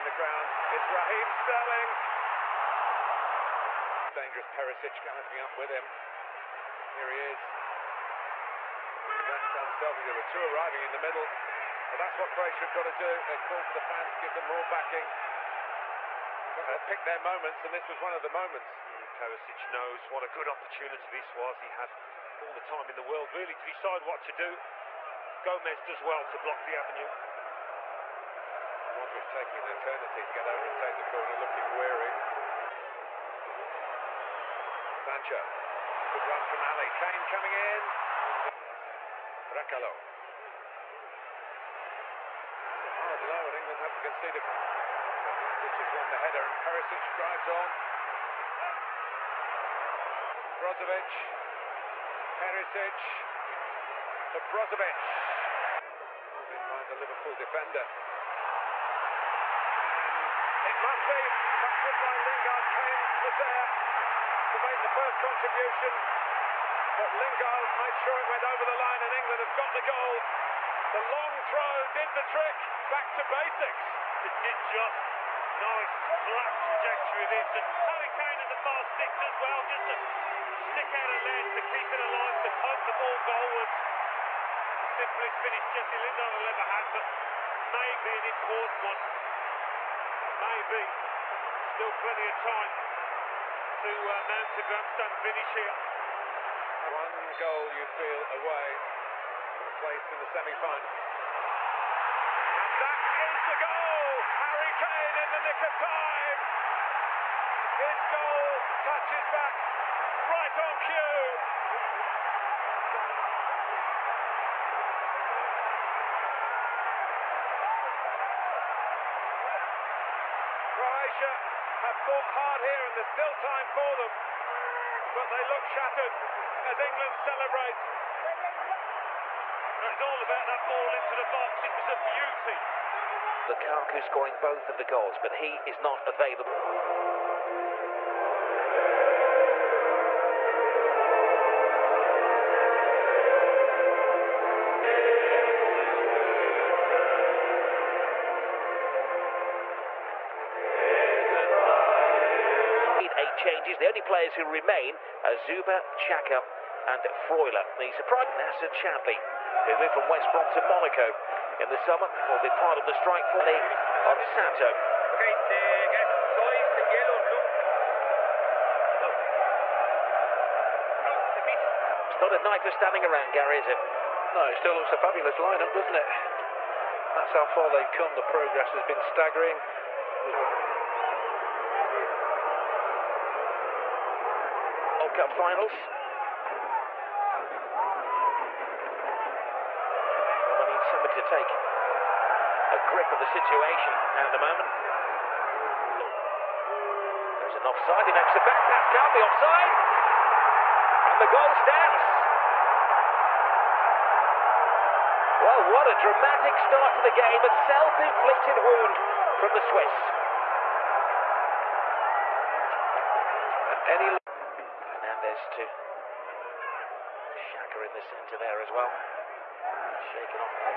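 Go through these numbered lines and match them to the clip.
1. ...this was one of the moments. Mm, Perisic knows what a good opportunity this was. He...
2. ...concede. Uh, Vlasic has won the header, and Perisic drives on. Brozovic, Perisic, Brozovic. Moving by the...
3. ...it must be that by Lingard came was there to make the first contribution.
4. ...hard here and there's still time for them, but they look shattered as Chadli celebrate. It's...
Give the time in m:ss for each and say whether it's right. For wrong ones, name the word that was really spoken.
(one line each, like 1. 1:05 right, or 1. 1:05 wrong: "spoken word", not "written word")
1. 0:17 right
2. 0:44 right
3. 1:00 right
4. 2:02 wrong: "England", not "Chadli".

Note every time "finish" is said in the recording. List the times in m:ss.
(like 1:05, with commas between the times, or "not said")
1:25, 1:35.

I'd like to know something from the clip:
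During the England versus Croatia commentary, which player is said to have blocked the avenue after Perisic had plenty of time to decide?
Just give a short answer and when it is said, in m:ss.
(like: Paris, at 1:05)
Gomez, at 0:25.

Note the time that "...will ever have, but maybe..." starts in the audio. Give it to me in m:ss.
1:26.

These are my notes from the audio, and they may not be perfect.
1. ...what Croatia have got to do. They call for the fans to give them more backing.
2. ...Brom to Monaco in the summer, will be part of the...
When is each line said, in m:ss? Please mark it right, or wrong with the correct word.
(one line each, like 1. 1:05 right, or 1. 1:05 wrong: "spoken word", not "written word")
1. 0:12 right
2. 2:40 right.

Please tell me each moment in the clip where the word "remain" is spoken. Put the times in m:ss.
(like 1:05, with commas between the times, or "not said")
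2:34.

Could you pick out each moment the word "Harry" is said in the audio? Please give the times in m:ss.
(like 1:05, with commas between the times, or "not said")
1:17, 1:44.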